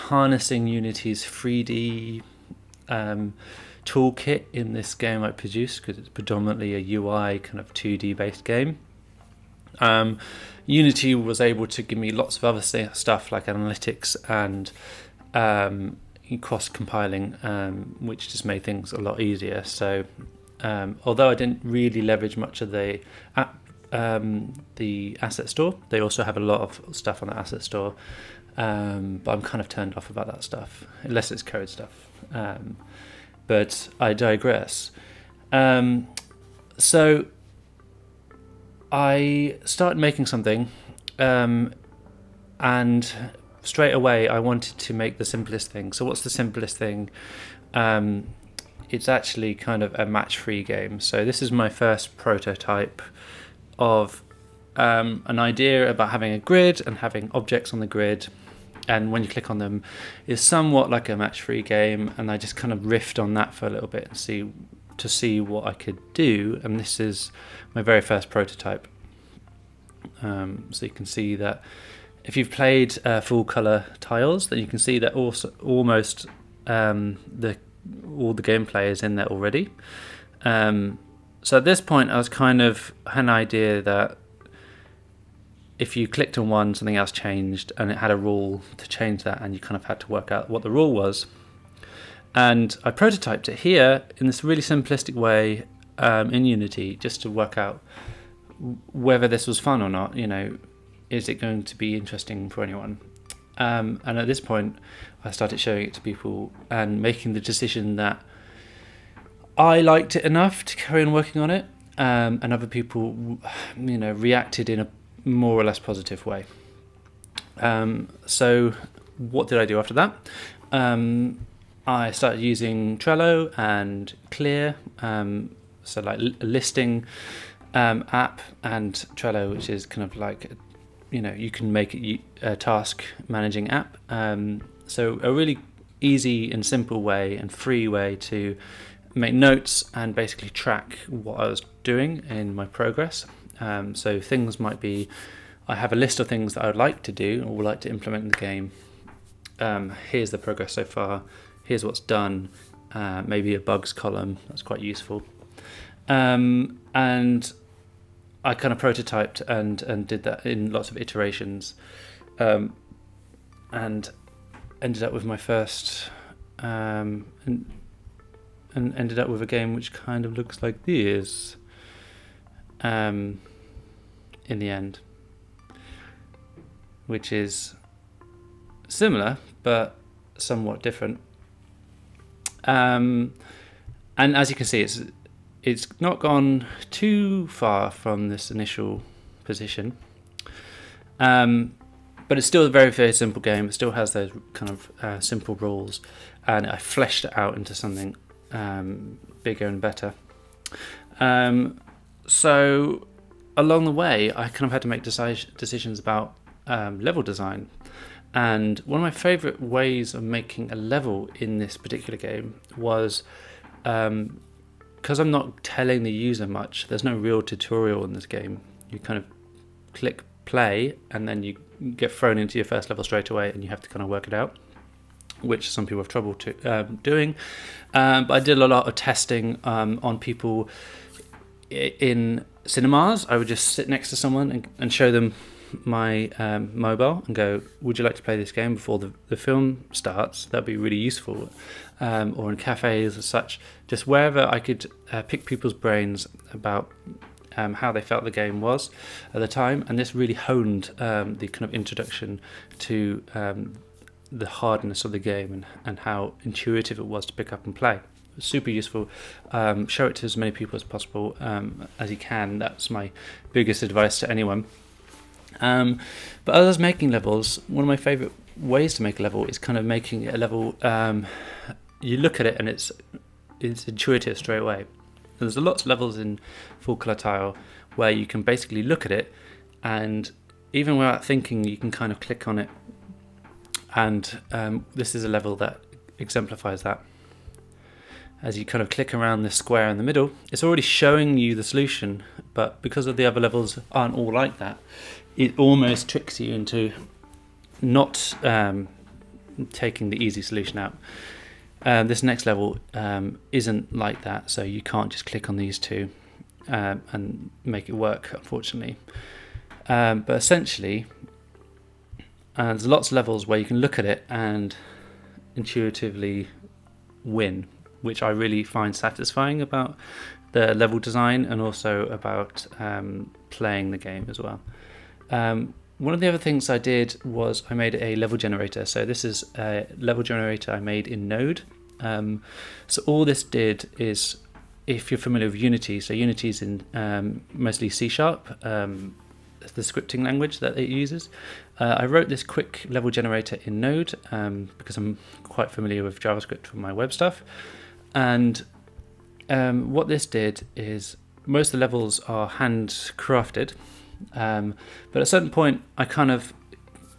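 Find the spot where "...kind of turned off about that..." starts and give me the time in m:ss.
0:29.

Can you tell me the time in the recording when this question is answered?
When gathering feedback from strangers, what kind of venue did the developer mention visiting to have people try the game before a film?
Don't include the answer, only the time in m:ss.
3:52.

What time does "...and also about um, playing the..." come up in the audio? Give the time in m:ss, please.
5:21.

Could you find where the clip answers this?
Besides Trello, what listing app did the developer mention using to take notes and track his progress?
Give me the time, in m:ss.
2:04.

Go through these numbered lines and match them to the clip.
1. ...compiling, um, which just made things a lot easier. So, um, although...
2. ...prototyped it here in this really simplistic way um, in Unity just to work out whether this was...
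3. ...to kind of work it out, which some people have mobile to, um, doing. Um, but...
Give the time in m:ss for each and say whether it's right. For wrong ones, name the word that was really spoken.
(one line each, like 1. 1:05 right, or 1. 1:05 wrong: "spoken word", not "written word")
1. 0:16 right
2. 1:32 right
3. 3:43 wrong: "trouble", not "mobile".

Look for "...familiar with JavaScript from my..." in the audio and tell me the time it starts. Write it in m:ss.
5:45.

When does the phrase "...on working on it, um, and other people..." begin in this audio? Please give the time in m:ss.
1:51.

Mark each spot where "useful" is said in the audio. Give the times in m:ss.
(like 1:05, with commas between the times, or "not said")
2:34, 4:00, 4:18.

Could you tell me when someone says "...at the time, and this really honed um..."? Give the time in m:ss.
4:09.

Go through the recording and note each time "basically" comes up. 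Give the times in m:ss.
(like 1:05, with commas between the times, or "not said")
2:20, 4:38.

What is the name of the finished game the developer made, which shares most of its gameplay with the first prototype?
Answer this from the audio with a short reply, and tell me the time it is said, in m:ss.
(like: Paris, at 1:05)
Full Color Tiles, at 1:13.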